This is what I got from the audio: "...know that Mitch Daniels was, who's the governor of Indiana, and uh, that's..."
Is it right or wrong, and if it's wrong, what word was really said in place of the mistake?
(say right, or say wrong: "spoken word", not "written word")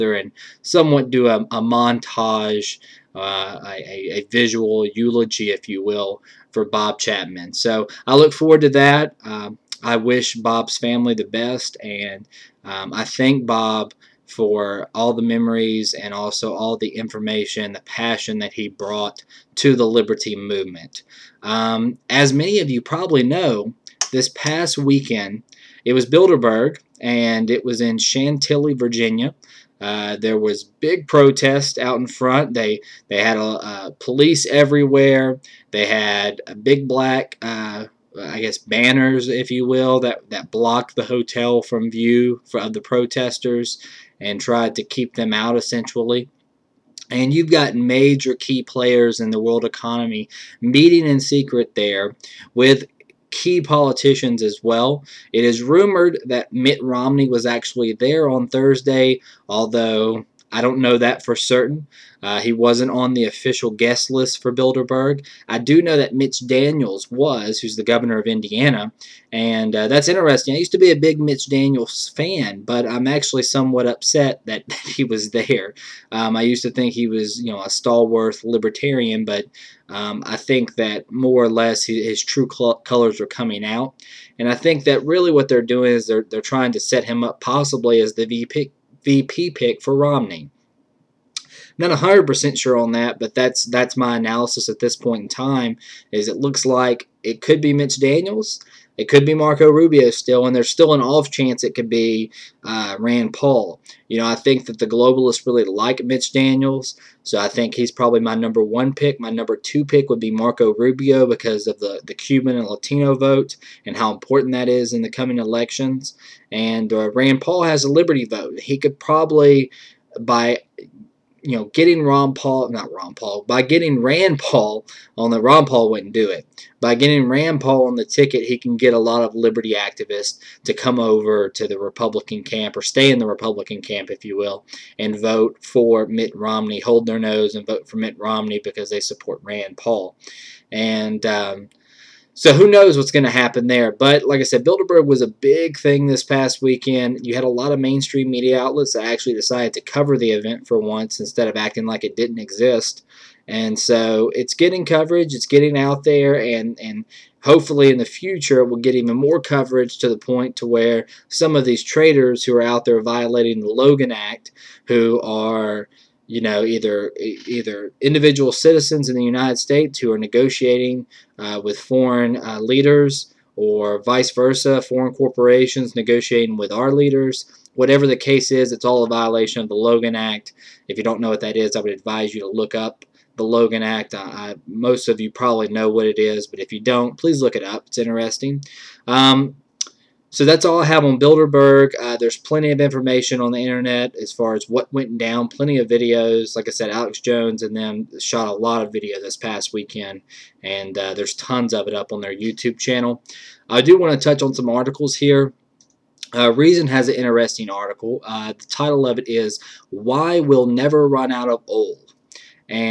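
right.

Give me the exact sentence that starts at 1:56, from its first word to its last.
And uh, Rand Paul has a liberty vote.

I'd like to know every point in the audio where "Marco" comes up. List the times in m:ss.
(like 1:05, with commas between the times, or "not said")
1:39, 1:50.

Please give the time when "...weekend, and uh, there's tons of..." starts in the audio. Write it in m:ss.
3:19.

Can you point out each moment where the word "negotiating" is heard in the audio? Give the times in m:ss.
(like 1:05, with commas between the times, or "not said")
2:50, 2:55.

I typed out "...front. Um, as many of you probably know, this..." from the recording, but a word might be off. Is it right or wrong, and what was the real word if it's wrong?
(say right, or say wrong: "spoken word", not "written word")
wrong: "movement", not "front".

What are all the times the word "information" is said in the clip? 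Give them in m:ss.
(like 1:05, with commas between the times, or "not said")
0:16, 3:12.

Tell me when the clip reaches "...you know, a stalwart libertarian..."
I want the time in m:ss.
1:17.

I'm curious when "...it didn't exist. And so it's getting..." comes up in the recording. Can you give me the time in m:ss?
2:32.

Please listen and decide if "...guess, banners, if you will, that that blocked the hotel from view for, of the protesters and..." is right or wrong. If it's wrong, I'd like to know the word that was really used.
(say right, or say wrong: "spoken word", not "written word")
right.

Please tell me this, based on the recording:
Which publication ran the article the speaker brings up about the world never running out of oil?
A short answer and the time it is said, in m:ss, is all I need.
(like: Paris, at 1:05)
Reason, at 3:26.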